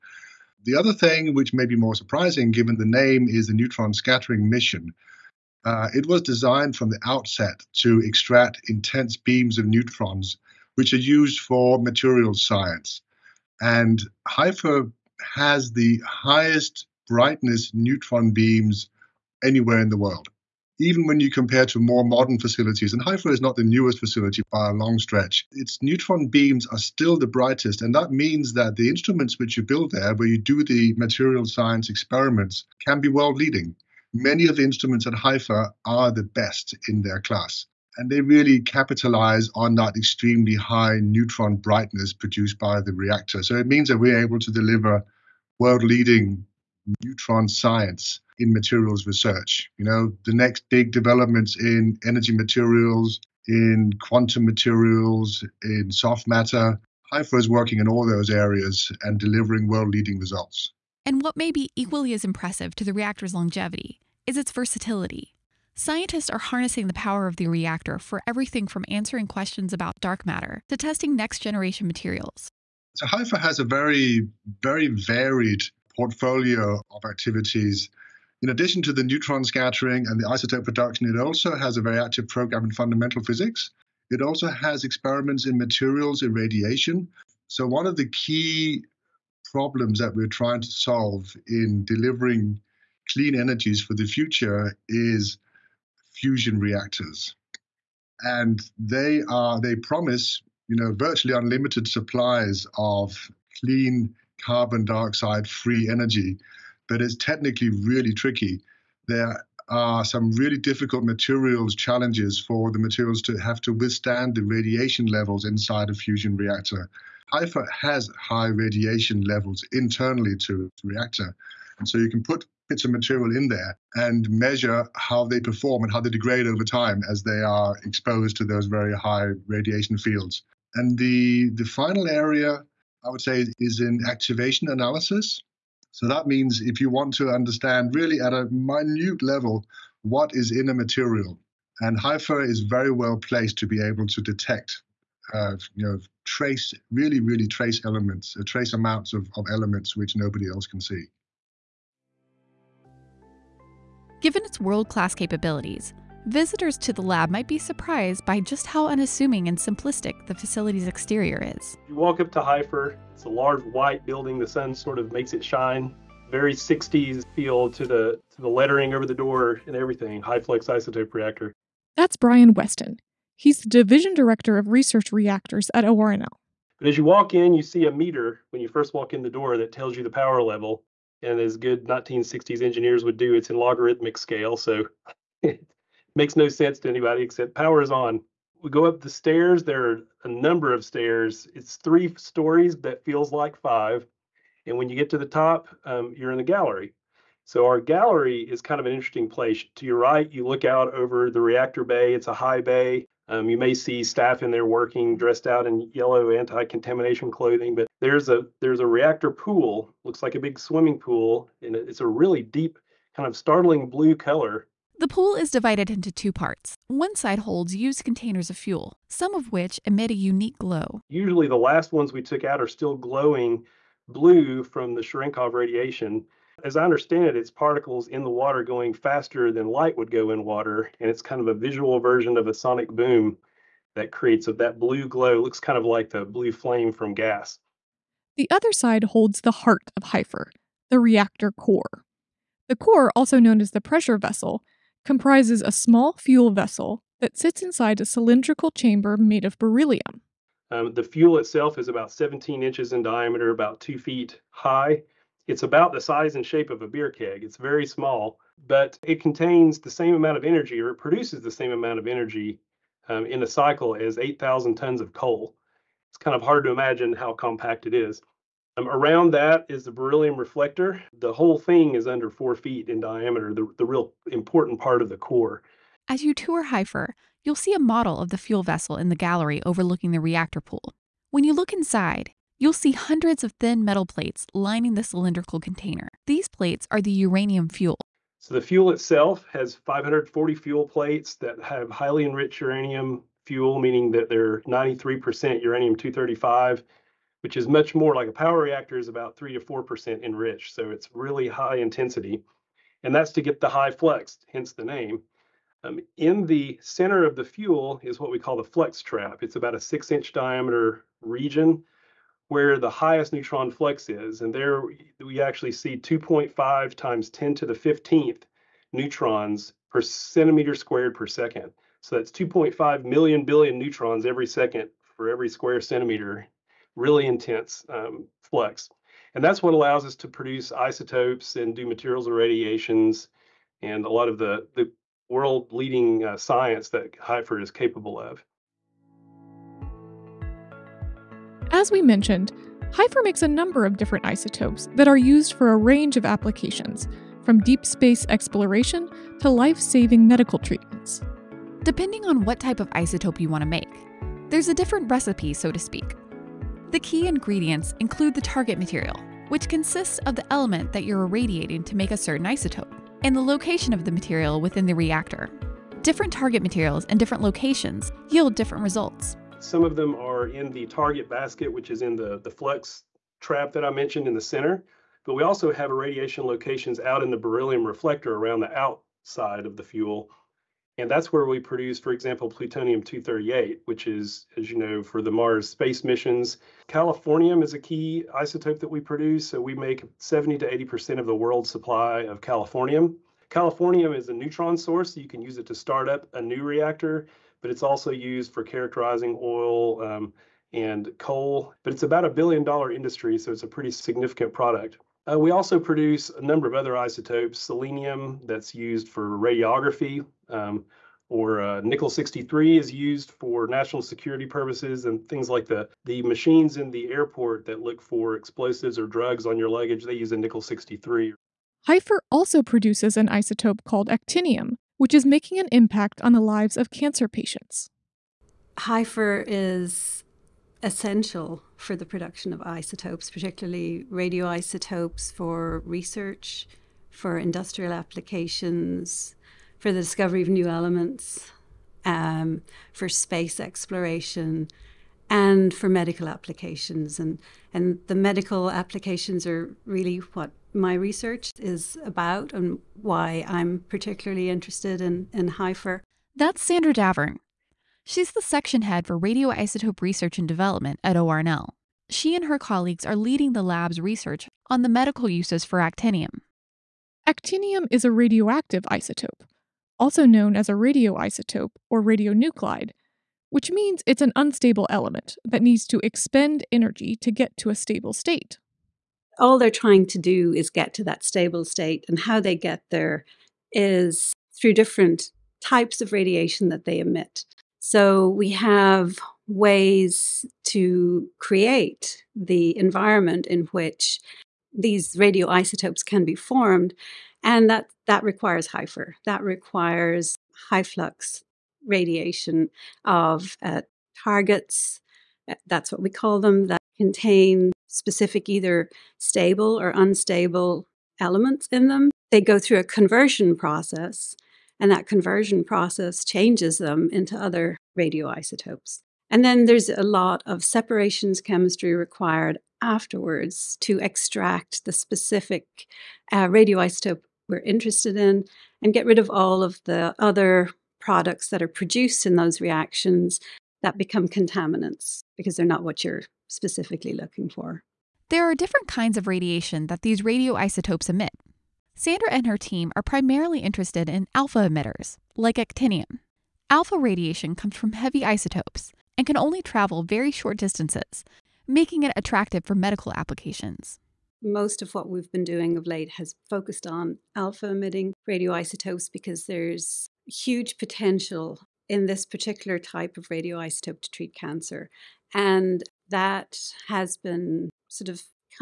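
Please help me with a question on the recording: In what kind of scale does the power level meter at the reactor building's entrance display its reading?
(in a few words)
logarithmic.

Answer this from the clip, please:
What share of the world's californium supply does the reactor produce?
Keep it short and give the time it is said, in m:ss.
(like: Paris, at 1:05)
70 to 80%, at 6:30.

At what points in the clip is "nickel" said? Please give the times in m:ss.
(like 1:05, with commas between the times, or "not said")
6:51, 7:00.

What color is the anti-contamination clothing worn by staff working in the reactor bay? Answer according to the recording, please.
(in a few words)
yellow.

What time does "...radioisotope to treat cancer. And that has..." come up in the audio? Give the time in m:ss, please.
9:23.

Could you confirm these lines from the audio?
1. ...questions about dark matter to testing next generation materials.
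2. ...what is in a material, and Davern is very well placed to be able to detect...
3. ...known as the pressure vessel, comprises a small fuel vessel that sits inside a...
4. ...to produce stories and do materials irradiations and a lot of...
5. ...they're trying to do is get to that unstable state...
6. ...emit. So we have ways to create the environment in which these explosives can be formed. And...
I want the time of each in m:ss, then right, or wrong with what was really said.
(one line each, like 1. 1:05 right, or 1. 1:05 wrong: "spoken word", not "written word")
1. 1:09 right
2. 2:20 wrong: "HFIR", not "Davern"
3. 4:03 right
4. 5:30 wrong: "isotopes", not "stories"
5. 7:59 wrong: "stable", not "unstable"
6. 8:06 wrong: "radioisotopes", not "explosives".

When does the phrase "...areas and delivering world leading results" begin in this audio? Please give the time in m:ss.
0:58.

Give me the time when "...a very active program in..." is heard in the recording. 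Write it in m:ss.
1:21.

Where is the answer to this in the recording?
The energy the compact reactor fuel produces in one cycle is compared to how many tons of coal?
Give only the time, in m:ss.
4:24.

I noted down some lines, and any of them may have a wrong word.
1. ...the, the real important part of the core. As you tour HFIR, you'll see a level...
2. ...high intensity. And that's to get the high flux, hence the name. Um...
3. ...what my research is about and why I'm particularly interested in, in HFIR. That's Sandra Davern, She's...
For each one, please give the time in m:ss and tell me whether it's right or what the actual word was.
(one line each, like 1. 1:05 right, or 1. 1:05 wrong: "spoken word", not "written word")
1. 4:33 wrong: "model", not "level"
2. 5:01 right
3. 7:30 right.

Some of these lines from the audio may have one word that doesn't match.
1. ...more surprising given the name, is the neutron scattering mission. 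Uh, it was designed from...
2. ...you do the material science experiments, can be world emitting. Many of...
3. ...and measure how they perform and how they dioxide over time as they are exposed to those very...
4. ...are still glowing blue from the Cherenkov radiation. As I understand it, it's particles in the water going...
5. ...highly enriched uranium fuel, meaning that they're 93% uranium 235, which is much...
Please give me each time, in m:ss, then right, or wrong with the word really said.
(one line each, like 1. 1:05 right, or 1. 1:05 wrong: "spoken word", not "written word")
1. 0:01 right
2. 0:30 wrong: "leading", not "emitting"
3. 2:03 wrong: "degrade", not "dioxide"
4. 3:42 right
5. 4:51 right.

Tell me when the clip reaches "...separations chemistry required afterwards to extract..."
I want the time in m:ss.
8:40.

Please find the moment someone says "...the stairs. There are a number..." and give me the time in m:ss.
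3:09.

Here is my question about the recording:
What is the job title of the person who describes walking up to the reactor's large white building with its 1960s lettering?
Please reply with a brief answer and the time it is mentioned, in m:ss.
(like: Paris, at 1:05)
division director of research reactors, at 2:53.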